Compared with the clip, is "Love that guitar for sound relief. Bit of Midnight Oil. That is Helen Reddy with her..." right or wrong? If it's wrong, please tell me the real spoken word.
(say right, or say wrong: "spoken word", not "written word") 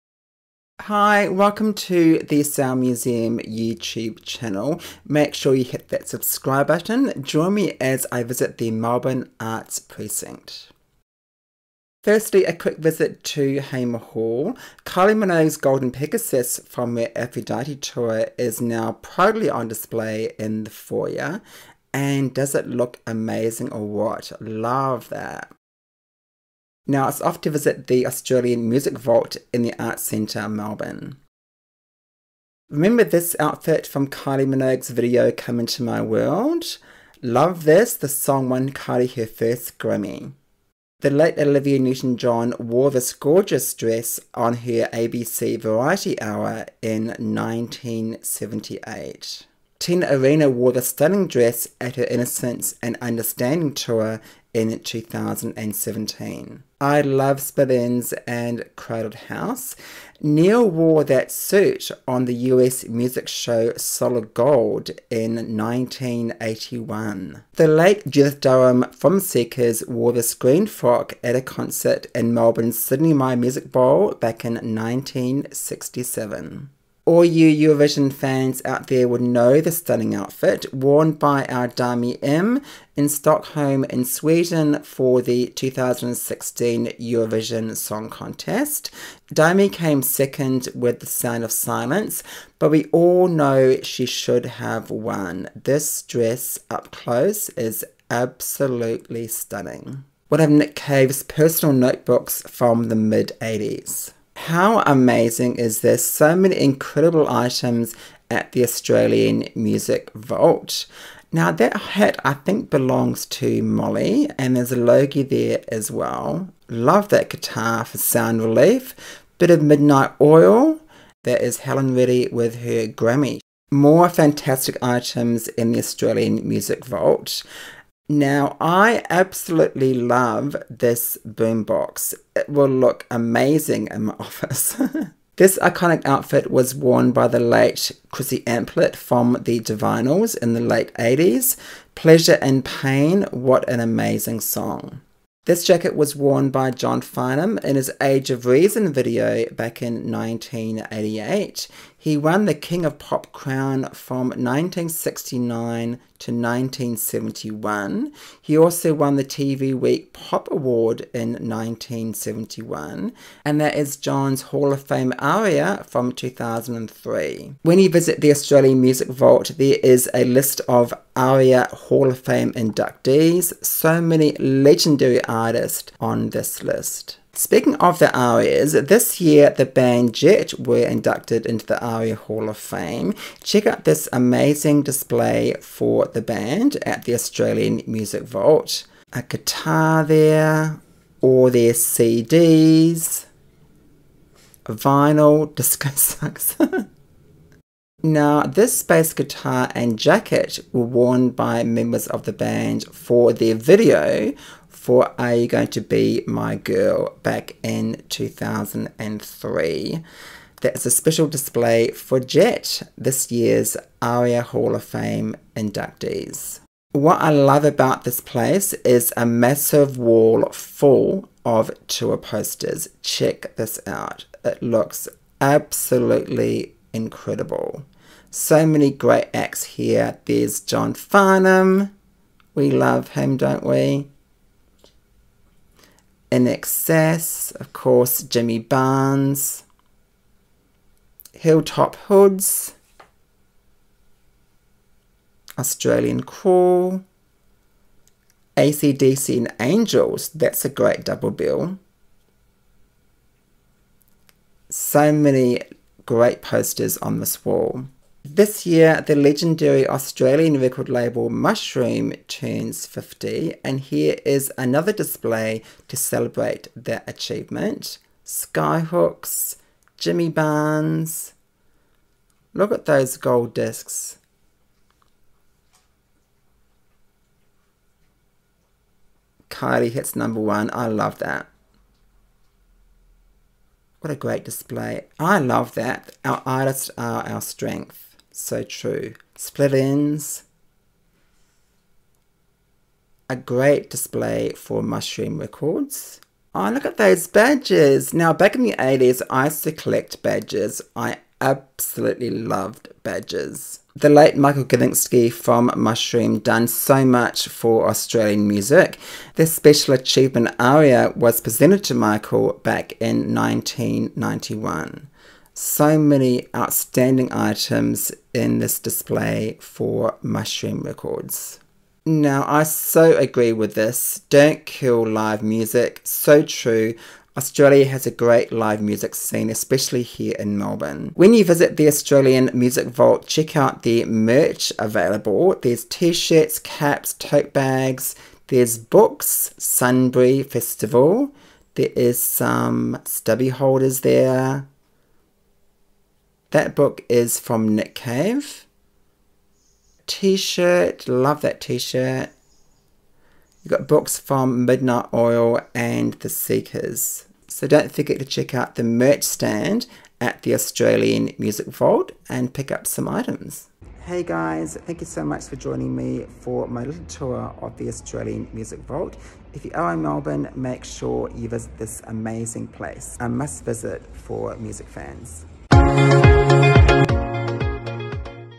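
right.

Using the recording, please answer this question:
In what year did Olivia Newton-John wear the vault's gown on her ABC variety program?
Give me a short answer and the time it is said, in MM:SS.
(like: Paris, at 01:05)
1978, at 00:47.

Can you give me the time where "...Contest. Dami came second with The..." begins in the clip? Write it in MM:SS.
01:28.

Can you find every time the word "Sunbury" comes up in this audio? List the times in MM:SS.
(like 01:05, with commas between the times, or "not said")
05:39.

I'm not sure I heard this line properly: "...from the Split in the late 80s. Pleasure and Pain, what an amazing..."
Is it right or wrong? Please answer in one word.
wrong.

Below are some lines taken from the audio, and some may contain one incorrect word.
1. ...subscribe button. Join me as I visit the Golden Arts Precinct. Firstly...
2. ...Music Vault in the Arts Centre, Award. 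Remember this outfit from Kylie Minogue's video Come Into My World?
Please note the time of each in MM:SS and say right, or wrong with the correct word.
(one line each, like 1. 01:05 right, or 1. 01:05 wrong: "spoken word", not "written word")
1. 00:06 wrong: "Melbourne", not "Golden"
2. 00:28 wrong: "Melbourne", not "Award".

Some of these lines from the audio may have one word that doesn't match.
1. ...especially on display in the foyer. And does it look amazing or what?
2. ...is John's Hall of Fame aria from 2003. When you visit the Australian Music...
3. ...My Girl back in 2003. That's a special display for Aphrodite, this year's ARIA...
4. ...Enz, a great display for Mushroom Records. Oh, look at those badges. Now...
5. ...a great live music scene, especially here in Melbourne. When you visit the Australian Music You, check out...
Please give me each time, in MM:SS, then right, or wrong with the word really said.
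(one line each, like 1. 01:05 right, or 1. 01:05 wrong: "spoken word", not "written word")
1. 00:19 wrong: "proudly", not "especially"
2. 02:43 right
3. 03:26 wrong: "Jet", not "Aphrodite"
4. 04:49 right
5. 05:28 wrong: "Vault", not "You".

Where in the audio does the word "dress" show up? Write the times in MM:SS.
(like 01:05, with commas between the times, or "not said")
00:43, 00:51, 01:36.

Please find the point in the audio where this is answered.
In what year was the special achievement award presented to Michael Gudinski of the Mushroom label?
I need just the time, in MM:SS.
05:13.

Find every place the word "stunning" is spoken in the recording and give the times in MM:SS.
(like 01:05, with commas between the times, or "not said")
00:50, 01:19, 01:39.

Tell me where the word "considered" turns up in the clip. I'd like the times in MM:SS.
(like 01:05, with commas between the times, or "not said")
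not said.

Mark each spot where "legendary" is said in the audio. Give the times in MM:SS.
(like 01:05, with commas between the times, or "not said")
02:54, 04:19.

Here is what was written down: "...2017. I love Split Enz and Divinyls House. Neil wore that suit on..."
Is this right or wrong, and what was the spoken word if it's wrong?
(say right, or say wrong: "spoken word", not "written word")
wrong: "Crowded", not "Divinyls".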